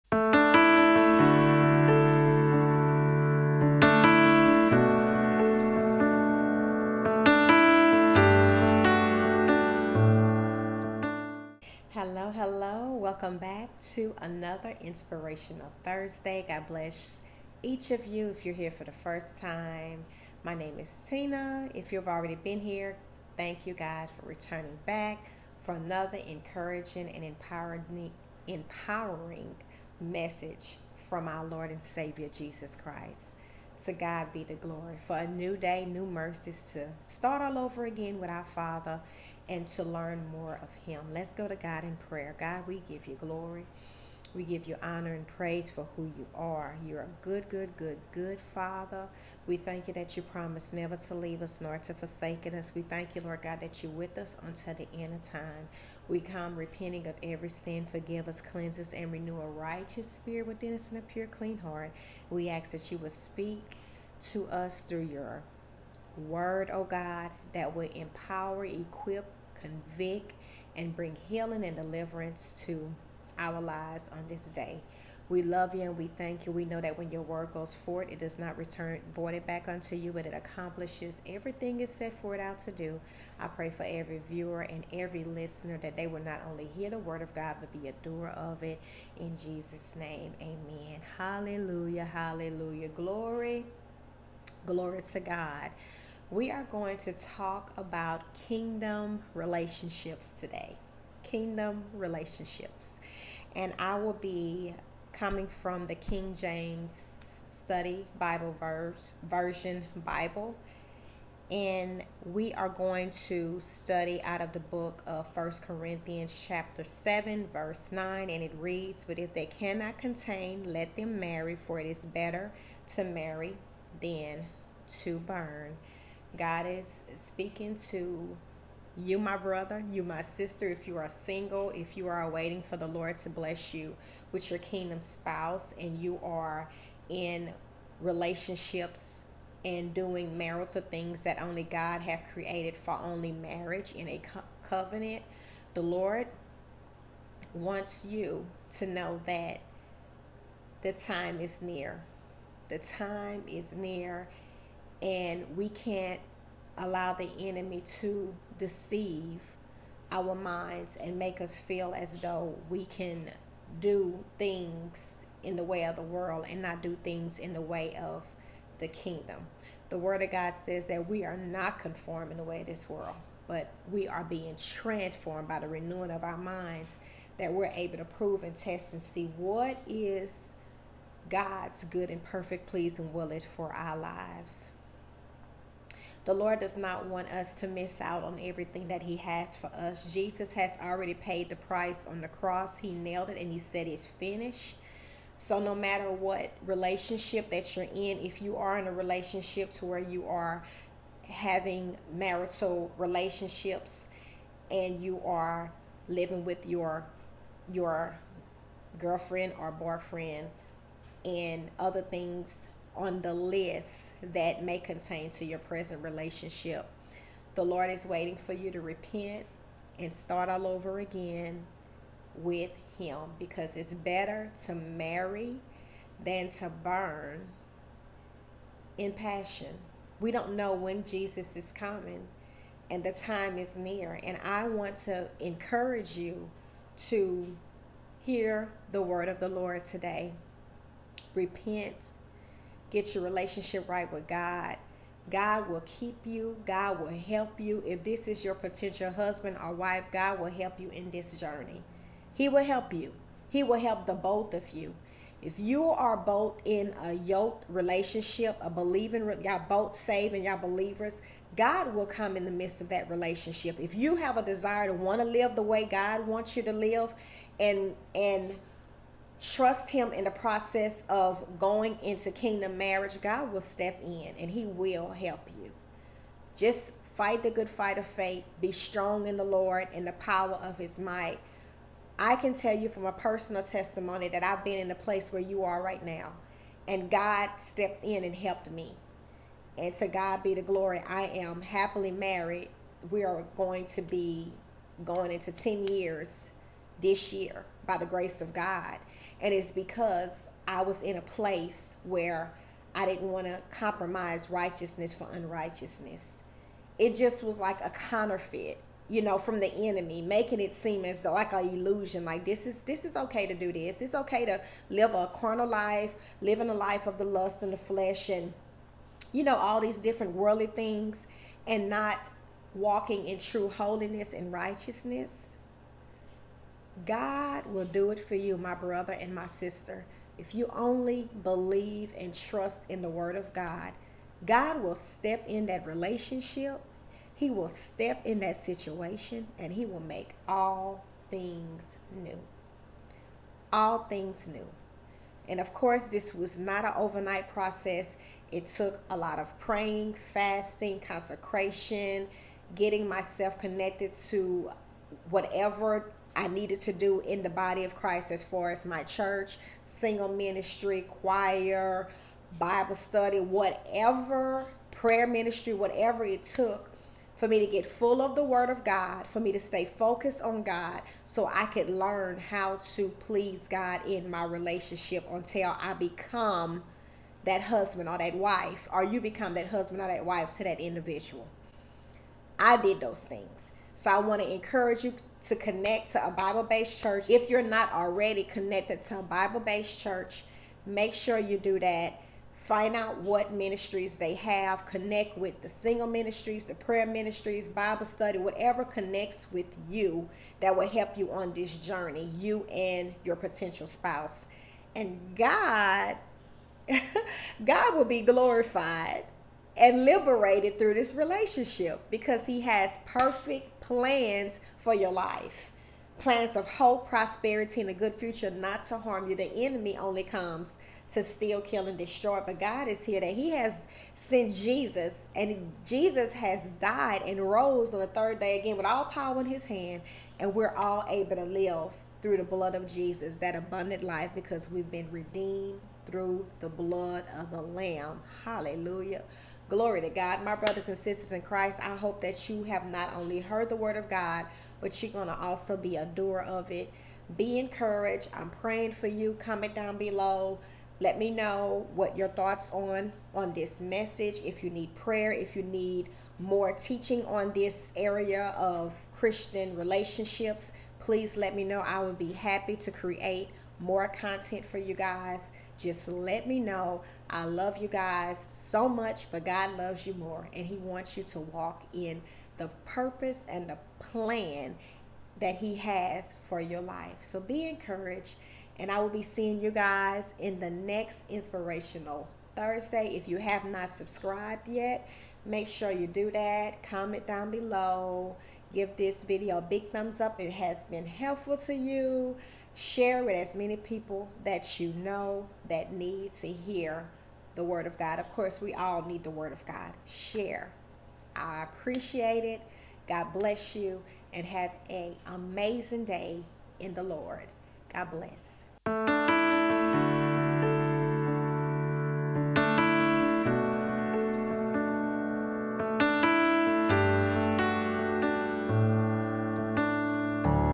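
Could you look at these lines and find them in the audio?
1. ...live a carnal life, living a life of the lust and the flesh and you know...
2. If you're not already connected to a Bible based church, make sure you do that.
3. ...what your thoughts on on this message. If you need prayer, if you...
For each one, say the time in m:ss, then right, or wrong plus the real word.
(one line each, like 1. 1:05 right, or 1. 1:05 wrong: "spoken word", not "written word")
1. 5:14 right
2. 6:27 right
3. 7:31 right.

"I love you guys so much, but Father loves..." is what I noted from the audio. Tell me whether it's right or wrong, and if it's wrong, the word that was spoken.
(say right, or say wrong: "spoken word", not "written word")
wrong: "God", not "Father".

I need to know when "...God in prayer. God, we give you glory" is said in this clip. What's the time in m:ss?
0:41.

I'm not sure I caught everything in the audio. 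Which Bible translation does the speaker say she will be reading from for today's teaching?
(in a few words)
King James Study Bible.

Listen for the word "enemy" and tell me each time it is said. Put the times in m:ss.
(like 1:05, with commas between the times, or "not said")
2:37, 5:09, 6:59.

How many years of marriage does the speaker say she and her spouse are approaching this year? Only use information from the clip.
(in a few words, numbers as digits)
10 years.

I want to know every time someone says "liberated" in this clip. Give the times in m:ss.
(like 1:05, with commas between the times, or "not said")
6:50.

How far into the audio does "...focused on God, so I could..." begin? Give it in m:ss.
6:09.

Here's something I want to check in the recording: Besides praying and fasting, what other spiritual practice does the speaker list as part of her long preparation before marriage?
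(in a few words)
Consecration.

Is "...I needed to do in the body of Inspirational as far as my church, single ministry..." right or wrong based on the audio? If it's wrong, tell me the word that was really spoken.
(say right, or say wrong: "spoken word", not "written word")
wrong: "Christ", not "Inspirational".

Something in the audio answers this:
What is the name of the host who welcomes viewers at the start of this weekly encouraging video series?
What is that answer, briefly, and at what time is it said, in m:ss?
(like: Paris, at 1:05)
Tina, at 0:21.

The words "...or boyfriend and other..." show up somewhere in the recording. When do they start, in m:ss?
3:29.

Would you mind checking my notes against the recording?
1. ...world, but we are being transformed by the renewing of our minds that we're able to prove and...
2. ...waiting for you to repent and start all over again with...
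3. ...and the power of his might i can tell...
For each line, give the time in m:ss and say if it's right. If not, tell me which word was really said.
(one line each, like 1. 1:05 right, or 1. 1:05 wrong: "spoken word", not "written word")
1. 2:52 right
2. 3:38 right
3. 4:39 right.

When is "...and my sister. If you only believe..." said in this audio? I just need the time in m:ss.
5:29.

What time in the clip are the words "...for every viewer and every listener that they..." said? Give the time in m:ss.
1:23.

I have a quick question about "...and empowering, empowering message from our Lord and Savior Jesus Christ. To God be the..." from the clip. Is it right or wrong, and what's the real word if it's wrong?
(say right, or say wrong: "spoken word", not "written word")
right.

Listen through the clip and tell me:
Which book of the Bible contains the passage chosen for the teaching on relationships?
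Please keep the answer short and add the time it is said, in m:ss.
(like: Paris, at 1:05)
First Corinthians, at 1:55.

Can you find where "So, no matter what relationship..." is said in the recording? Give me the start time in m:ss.
3:15.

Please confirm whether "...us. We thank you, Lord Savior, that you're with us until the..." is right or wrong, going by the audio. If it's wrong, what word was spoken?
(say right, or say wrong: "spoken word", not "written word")
wrong: "God", not "Savior".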